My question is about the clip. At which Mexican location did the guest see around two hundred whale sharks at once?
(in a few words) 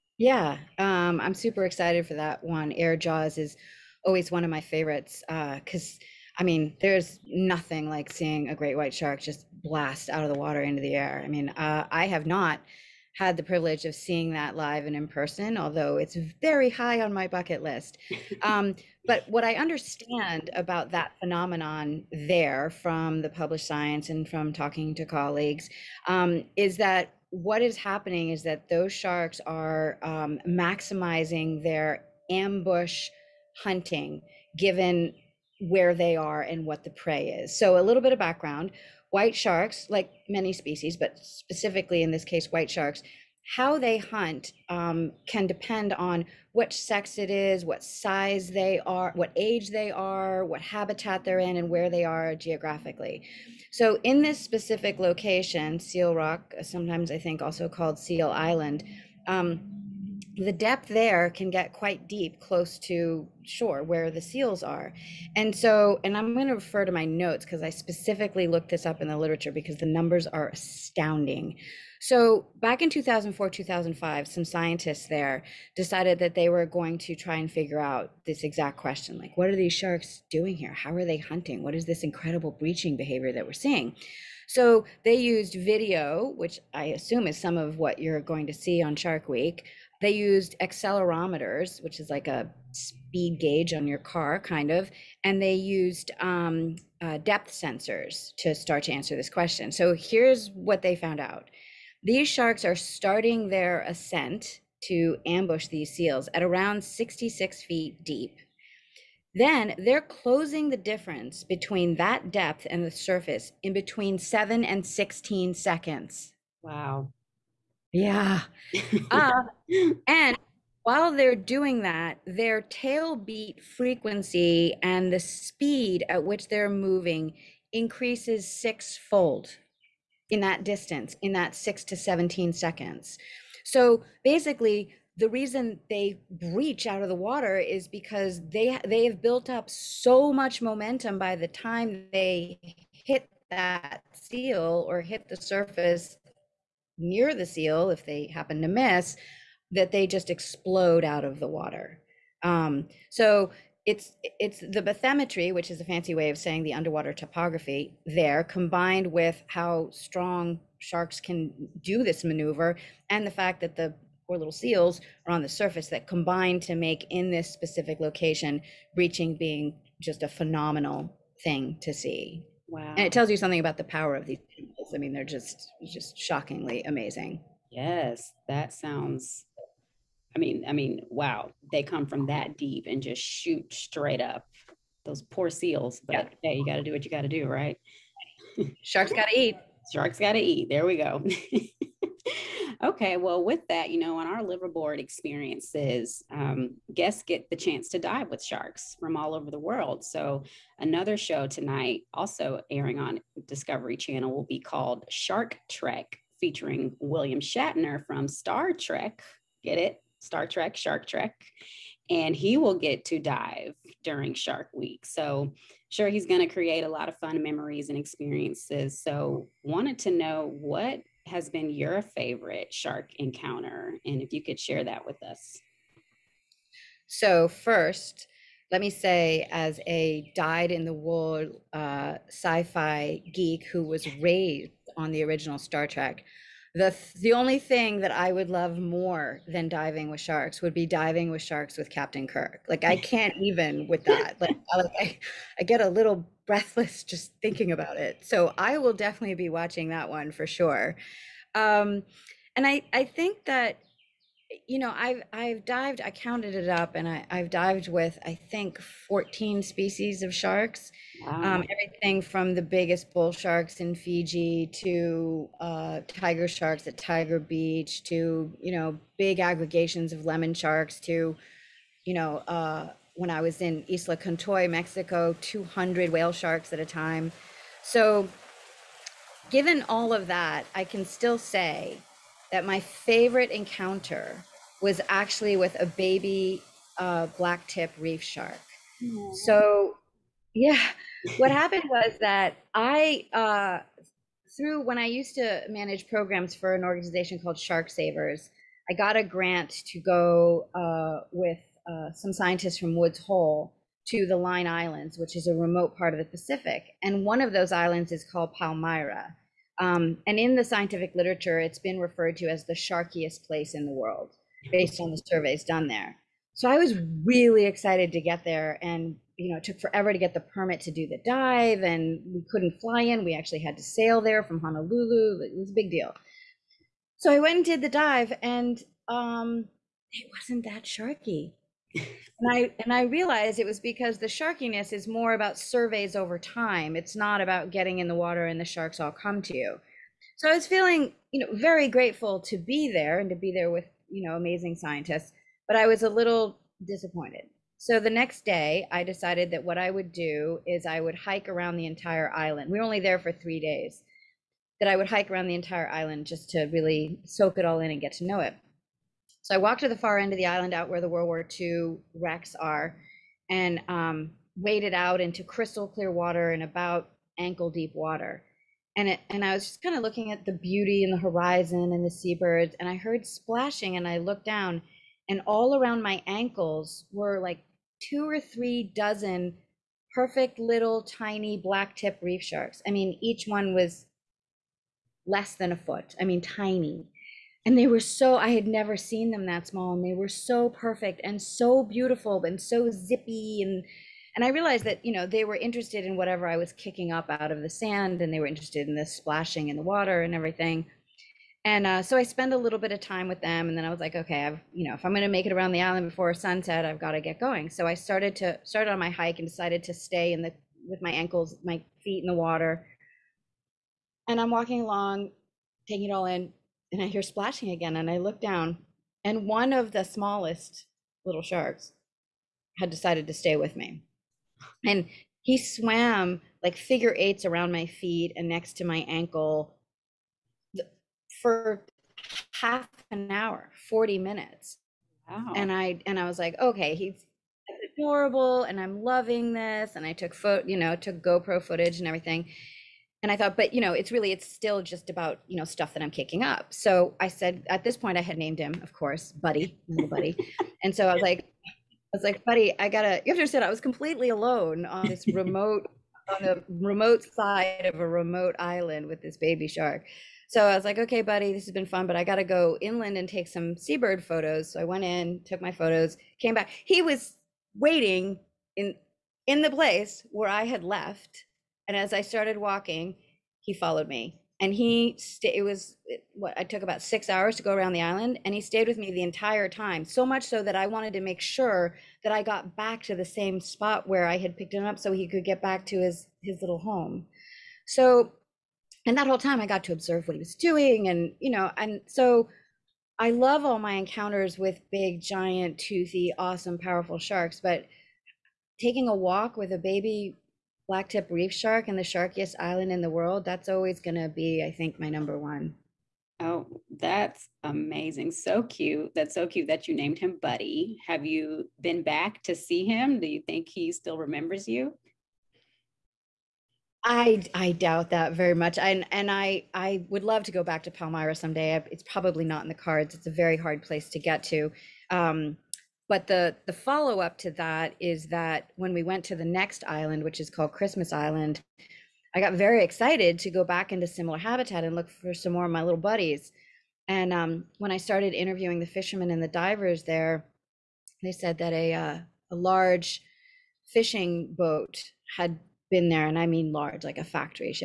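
Isla Contoy.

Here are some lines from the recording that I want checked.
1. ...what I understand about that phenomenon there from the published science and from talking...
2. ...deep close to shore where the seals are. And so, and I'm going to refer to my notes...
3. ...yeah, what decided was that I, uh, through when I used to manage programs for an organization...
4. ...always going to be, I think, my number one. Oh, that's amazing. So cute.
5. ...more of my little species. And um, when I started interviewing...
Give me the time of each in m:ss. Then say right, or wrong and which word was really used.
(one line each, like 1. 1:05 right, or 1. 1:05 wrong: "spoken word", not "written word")
1. 0:19 right
2. 1:02 right
3. 4:50 wrong: "happened", not "decided"
4. 8:23 right
5. 8:55 wrong: "buddies", not "species".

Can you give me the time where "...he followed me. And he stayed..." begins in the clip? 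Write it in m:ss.
7:53.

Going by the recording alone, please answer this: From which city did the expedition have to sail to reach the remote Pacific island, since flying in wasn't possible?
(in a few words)
Honolulu.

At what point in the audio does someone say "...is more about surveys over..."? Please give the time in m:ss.
5:34.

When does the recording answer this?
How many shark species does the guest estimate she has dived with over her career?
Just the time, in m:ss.
4:18.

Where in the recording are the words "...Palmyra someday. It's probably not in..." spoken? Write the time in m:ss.
8:40.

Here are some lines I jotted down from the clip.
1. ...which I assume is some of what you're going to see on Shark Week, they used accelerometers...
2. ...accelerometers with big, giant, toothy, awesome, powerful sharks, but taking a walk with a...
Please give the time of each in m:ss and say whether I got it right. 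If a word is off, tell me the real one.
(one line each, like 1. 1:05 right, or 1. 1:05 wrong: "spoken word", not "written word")
1. 1:26 right
2. 8:13 wrong: "encounters", not "accelerometers".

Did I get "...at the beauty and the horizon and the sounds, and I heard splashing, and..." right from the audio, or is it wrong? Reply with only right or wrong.
wrong.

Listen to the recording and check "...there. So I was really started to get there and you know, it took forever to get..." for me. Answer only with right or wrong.
wrong.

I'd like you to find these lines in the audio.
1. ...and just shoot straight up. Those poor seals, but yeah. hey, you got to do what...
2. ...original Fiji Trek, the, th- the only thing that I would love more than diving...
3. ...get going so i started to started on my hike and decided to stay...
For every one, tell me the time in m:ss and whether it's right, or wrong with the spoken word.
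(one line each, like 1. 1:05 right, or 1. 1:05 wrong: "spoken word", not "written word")
1. 3:02 right
2. 3:55 wrong: "Star", not "Fiji"
3. 6:47 right.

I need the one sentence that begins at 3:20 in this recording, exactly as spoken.
So, another show tonight, also airing on Discovery Channel, will be called Shark Trek, featuring William Shatner from Star Trek.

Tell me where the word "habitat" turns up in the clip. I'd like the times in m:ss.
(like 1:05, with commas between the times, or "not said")
0:50, 8:54.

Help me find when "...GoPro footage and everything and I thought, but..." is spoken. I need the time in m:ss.
7:21.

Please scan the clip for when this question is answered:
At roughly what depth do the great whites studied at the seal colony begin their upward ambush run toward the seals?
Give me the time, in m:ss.
1:46.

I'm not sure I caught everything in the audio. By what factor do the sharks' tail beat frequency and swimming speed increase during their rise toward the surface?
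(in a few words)
sixfold.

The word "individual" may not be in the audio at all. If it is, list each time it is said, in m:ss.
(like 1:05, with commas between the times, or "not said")
not said.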